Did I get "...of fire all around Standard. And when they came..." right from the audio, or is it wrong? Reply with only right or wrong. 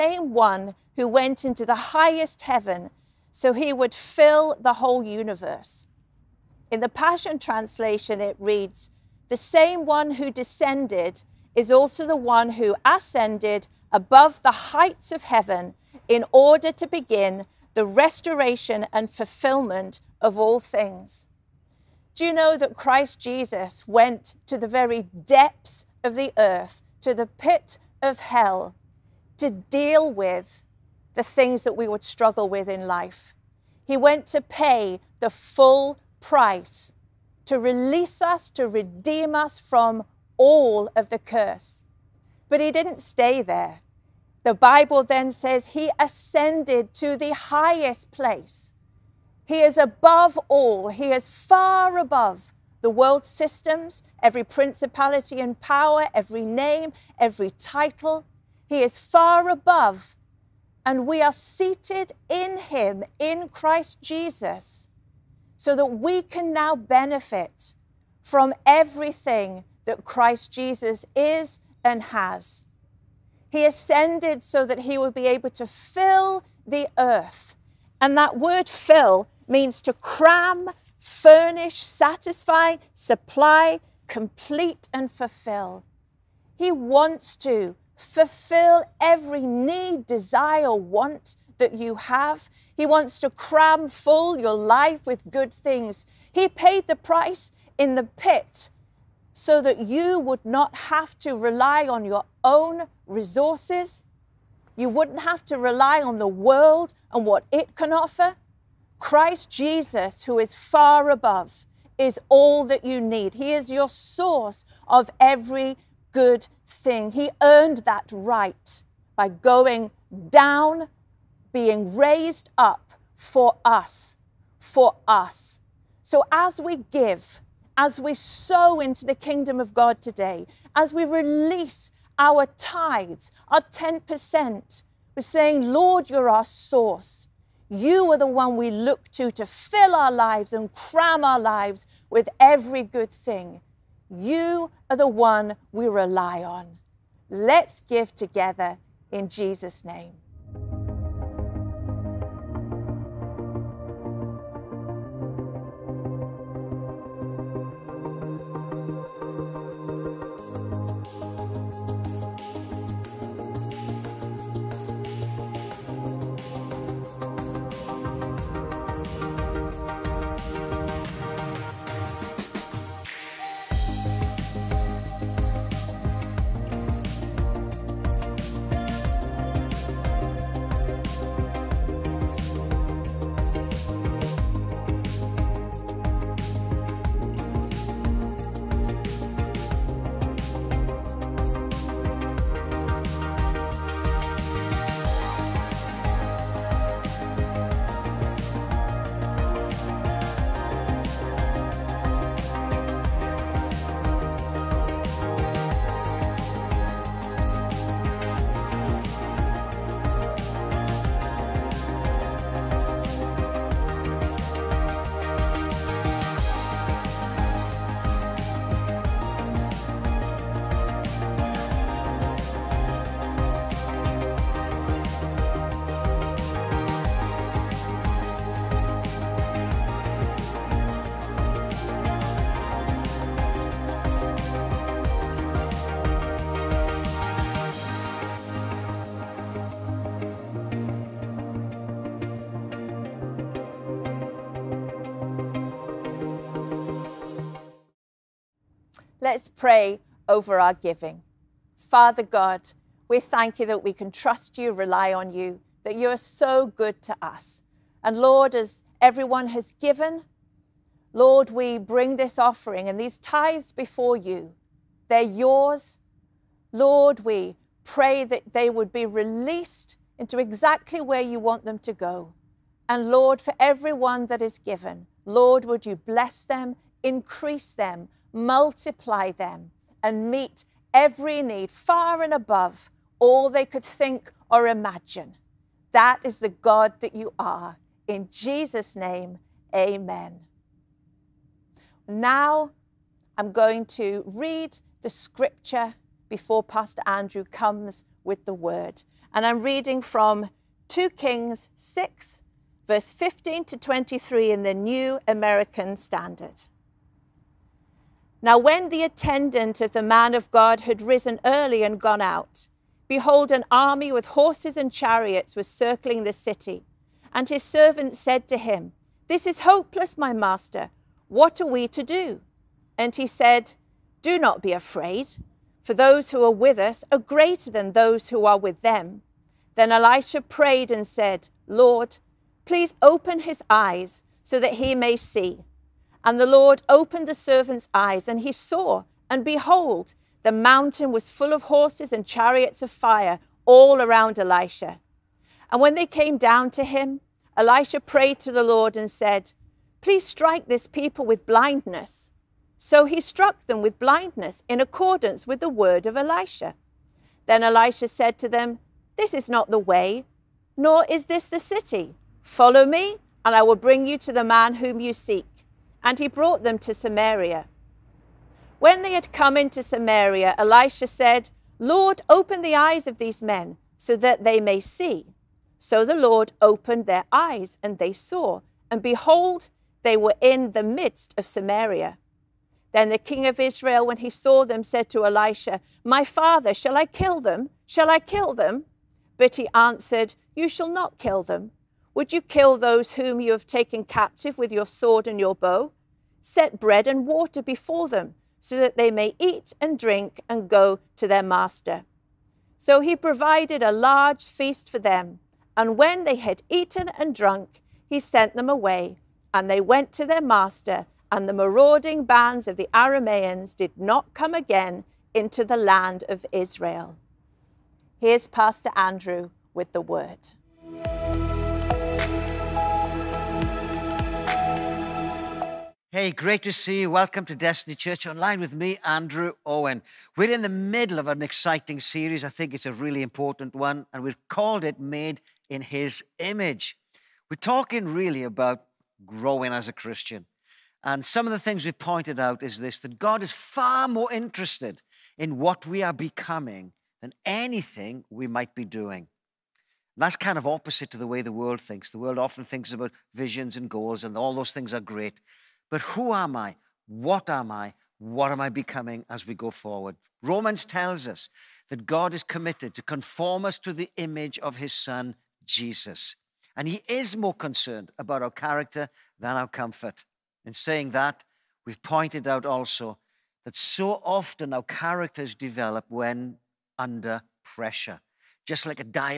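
wrong.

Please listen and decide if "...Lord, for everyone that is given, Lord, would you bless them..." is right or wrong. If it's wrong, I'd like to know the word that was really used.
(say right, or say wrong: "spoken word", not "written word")
right.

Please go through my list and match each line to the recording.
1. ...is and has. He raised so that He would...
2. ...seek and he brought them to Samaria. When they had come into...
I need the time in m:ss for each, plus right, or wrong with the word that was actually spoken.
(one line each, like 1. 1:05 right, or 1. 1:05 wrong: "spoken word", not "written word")
1. 1:11 wrong: "ascended", not "raised"
2. 6:05 right.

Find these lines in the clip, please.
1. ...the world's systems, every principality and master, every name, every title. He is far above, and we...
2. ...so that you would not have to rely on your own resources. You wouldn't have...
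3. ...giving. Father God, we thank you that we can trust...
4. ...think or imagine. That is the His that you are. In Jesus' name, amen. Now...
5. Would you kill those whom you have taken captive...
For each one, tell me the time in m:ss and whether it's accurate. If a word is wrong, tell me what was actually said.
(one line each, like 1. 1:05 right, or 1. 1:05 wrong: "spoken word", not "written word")
1. 0:52 wrong: "power", not "master"
2. 1:39 right
3. 4:10 right
4. 4:43 wrong: "God", not "His"
5. 6:32 right.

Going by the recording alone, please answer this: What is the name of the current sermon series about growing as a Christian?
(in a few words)
Made in His Image.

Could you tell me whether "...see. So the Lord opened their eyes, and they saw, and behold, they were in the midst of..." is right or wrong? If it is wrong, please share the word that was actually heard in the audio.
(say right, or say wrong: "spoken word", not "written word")
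right.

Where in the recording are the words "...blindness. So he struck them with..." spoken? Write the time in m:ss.
5:51.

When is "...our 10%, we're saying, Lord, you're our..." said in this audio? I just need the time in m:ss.
2:13.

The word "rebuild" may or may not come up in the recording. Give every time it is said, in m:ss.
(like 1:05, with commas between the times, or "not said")
not said.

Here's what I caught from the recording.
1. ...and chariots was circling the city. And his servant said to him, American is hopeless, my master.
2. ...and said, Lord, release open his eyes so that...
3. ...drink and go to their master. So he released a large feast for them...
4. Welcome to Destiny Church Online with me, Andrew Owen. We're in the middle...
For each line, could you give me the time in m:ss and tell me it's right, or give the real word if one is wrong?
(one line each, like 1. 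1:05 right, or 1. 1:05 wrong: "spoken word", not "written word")
1. 5:14 wrong: "This", not "American"
2. 5:30 wrong: "please", not "release"
3. 6:39 wrong: "provided", not "released"
4. 7:07 right.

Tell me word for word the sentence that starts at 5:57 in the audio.
Then Elisha said to them, This is not the way, nor is this the city.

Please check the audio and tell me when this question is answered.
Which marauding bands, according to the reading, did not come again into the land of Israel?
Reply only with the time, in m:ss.
6:52.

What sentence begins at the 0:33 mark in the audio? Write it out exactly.
He went to pay the full price to release us, to redeem us from all of the curse.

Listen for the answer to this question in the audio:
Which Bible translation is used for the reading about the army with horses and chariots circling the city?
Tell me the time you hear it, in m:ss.
5:04.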